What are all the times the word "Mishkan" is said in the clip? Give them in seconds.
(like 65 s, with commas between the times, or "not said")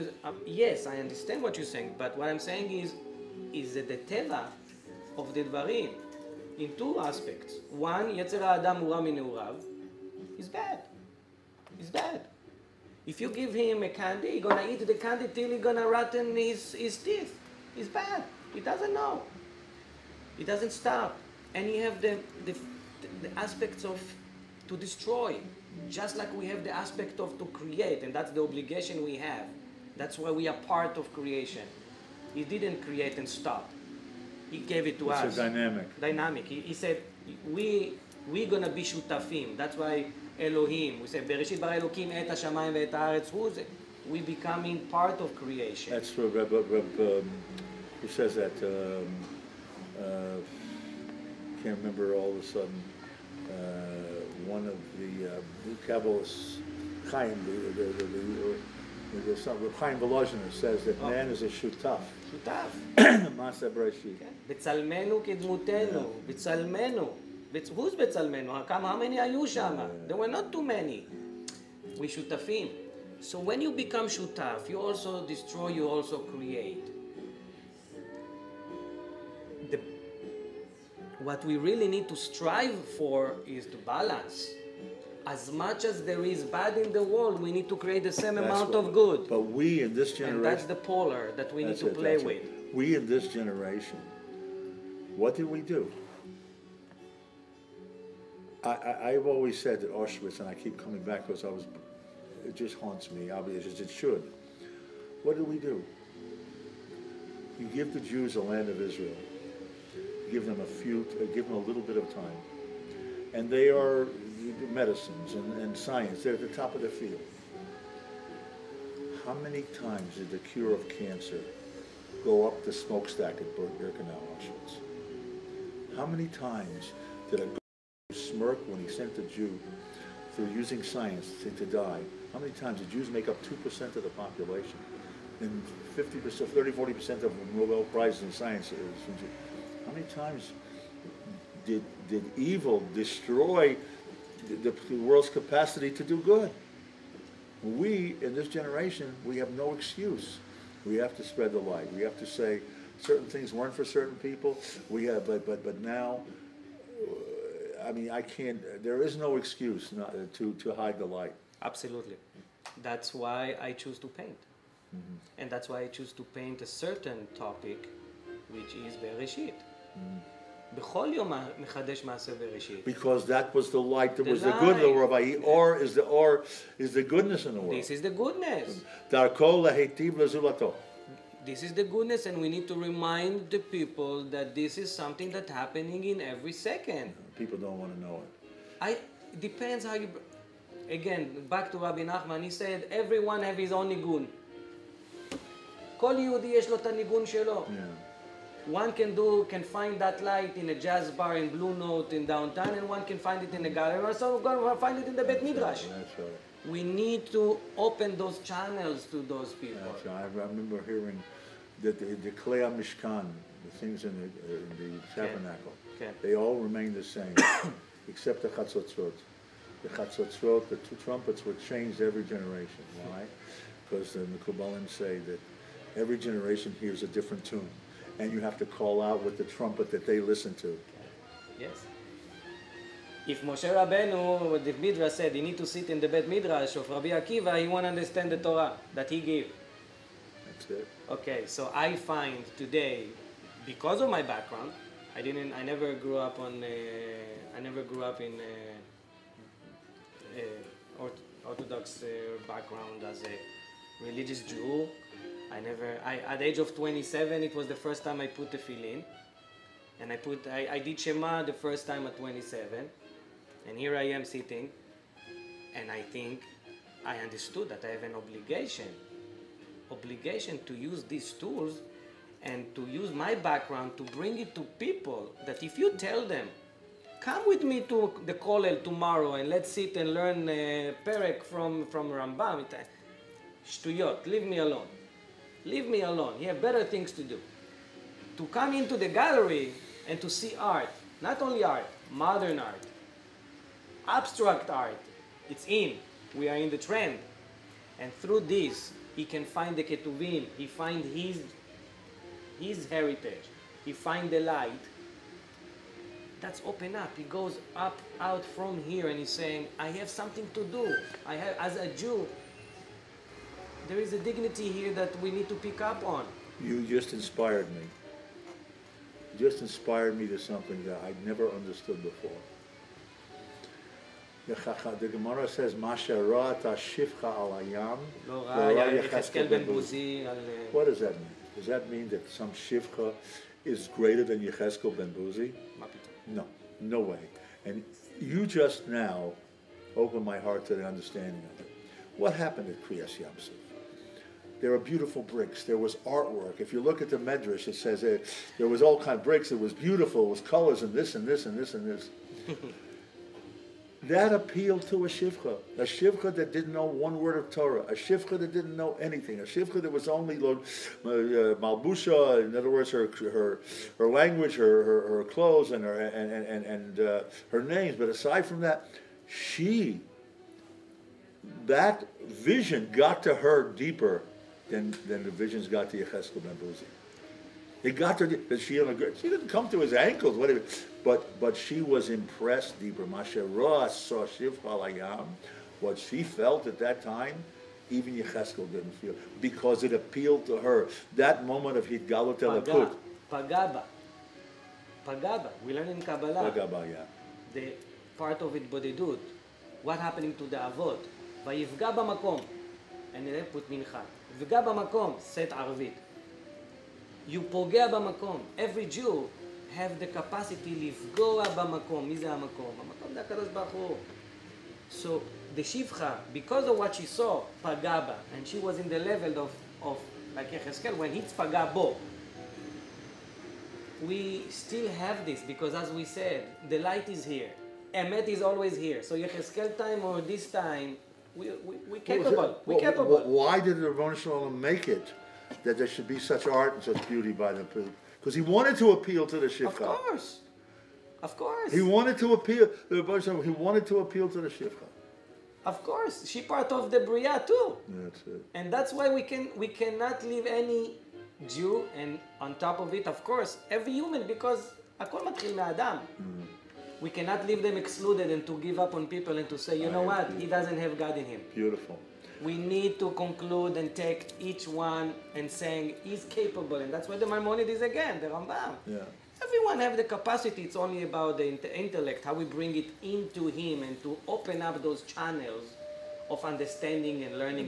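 212 s.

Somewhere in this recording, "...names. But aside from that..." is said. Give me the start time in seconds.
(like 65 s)
367 s.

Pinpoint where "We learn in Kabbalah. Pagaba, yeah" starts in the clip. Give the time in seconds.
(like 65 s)
395 s.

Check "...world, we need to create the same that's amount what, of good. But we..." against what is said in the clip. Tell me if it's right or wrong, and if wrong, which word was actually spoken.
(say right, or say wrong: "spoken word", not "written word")
right.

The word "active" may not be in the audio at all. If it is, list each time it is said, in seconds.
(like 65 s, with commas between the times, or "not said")
not said.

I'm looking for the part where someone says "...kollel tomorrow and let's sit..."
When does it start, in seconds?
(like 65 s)
278 s.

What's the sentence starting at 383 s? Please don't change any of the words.
Masherah saw Shiv Halayam, what she felt at that time, even Yecheskel didn't feel because it appealed to her.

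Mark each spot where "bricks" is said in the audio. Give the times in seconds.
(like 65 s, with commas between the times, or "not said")
345 s, 349 s.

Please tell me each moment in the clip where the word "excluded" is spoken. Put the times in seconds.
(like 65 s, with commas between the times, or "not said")
457 s.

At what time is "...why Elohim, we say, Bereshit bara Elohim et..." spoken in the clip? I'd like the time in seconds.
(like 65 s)
39 s.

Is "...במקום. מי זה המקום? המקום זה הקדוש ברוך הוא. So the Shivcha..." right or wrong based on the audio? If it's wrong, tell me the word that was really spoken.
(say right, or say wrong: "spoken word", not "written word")
right.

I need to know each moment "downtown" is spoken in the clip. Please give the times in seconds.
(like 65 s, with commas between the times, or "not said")
202 s.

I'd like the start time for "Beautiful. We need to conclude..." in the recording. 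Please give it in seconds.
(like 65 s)
461 s.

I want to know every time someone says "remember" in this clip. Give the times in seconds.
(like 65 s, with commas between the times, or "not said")
51 s, 210 s.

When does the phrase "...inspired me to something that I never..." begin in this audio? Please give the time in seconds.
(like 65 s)
319 s.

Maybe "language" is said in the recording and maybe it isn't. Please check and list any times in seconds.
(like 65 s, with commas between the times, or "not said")
364 s.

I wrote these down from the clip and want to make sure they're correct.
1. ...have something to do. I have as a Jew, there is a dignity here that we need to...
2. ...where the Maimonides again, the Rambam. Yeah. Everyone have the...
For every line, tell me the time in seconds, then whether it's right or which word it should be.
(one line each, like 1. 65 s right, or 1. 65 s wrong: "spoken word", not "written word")
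1. 309 s right
2. 467 s right.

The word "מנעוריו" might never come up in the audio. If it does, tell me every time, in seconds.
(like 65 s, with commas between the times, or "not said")
9 s.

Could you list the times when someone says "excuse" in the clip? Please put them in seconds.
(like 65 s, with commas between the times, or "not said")
149 s, 159 s.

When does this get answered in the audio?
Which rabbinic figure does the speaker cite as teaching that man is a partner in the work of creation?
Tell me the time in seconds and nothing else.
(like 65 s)
59 s.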